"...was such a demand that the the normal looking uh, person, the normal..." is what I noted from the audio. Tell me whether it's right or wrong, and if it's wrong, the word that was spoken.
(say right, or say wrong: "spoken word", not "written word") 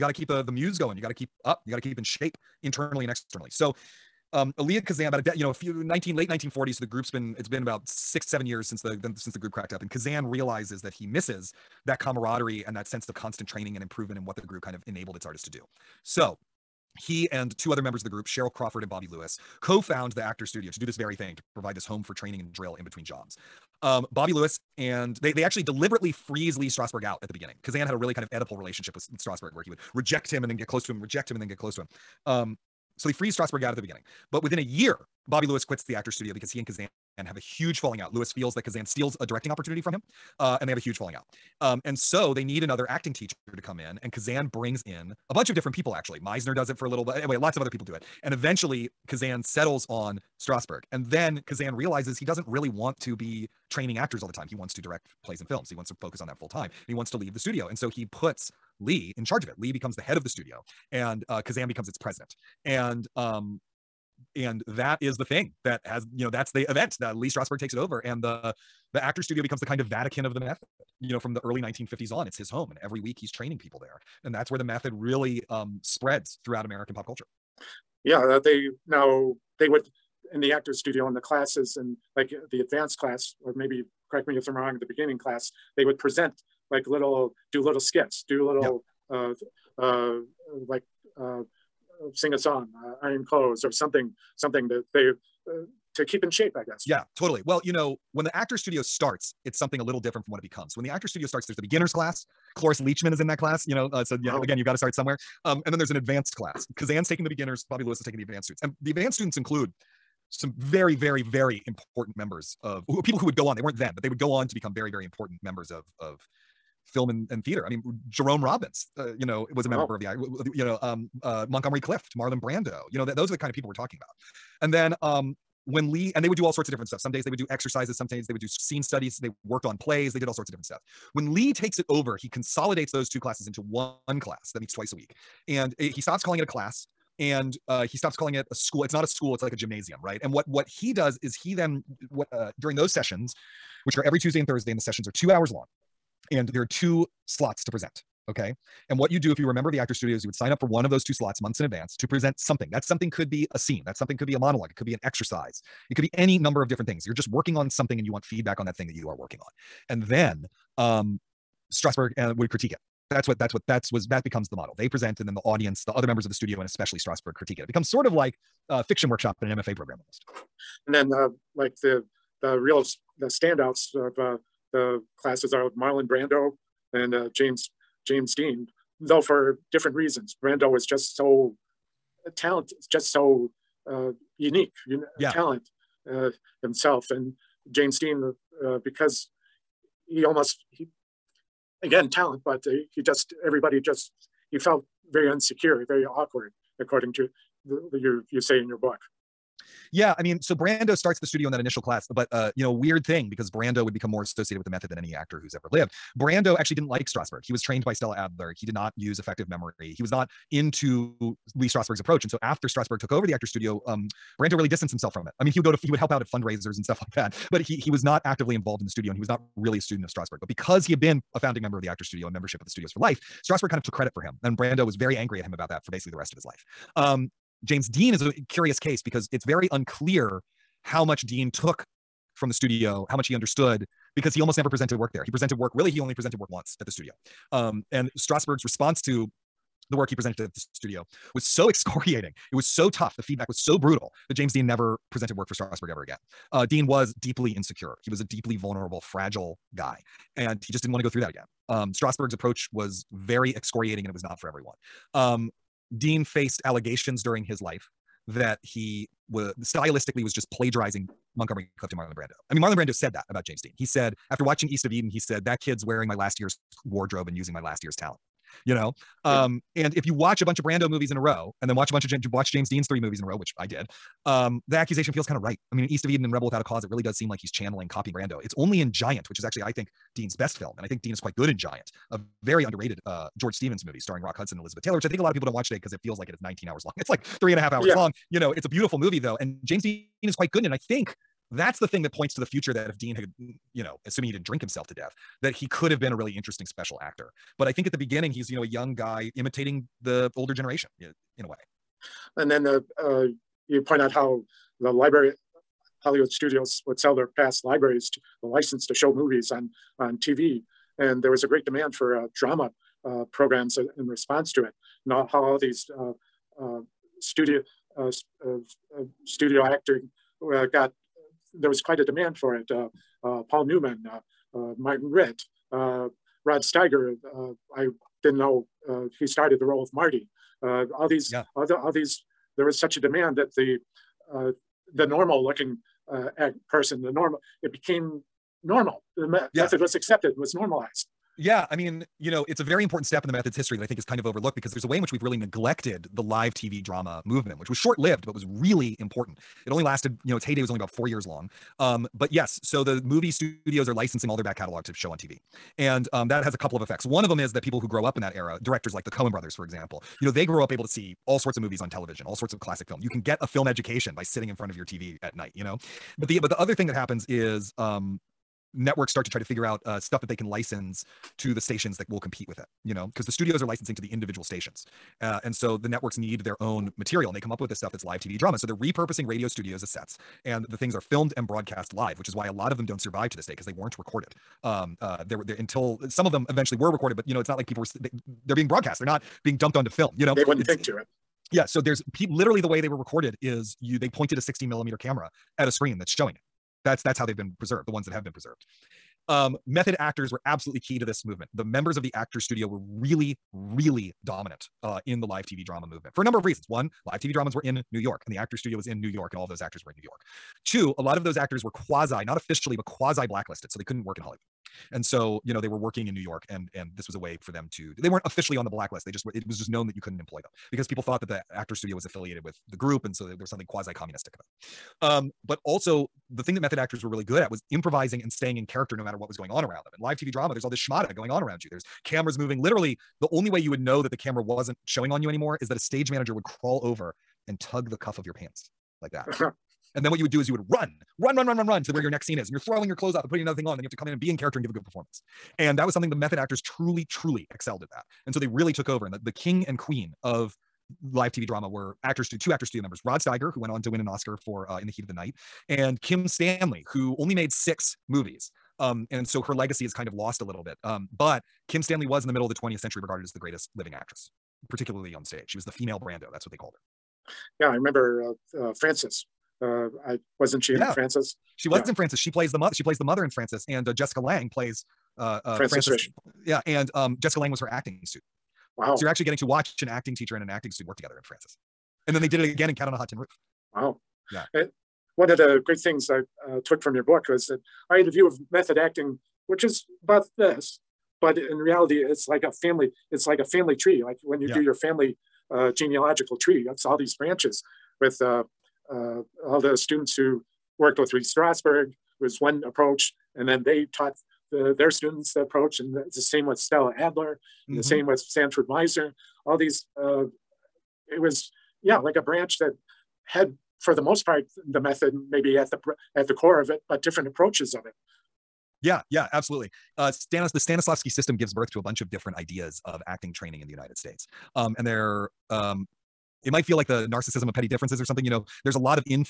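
right.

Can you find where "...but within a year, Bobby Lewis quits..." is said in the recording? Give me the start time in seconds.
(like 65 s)
34 s.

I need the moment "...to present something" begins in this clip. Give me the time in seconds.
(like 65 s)
151 s.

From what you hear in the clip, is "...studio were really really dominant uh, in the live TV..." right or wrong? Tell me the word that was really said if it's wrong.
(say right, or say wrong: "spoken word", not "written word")
right.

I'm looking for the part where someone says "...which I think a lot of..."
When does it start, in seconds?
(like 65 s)
284 s.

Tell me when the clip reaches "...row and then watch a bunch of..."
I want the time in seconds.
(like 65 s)
271 s.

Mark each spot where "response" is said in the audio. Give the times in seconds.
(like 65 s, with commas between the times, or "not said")
238 s, 314 s.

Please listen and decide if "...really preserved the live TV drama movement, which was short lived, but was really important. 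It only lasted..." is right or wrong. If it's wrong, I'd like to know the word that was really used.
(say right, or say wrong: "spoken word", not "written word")
wrong: "neglected", not "preserved".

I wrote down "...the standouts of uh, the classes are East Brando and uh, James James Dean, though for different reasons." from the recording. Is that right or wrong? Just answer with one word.
wrong.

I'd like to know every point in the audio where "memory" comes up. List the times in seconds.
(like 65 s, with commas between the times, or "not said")
209 s.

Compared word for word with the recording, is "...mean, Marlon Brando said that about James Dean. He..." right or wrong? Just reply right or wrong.
right.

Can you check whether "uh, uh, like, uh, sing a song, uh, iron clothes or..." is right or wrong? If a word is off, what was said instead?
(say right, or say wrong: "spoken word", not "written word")
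right.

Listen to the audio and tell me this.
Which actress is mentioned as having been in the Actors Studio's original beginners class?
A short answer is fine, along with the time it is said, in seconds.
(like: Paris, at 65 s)
Cloris Leachman, at 102 s.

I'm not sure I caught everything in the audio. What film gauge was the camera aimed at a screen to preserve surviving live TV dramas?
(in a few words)
16 millimeter.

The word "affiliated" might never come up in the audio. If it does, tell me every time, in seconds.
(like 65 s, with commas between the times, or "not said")
422 s.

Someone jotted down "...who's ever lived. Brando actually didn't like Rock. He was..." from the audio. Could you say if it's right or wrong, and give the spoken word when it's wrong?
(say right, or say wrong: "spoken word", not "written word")
wrong: "Strasberg", not "Rock".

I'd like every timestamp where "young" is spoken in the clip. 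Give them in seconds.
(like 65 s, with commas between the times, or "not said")
298 s.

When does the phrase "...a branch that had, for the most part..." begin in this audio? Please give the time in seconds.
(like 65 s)
512 s.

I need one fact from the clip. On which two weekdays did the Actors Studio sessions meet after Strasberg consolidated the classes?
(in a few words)
Tuesday and Thursday.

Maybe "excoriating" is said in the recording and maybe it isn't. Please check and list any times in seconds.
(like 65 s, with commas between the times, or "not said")
241 s, 253 s.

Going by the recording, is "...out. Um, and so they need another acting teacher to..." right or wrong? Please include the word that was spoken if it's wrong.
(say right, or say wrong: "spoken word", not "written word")
right.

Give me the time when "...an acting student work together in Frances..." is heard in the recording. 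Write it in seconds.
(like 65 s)
480 s.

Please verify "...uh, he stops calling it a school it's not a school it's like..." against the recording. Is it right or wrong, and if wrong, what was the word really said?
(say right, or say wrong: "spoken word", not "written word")
right.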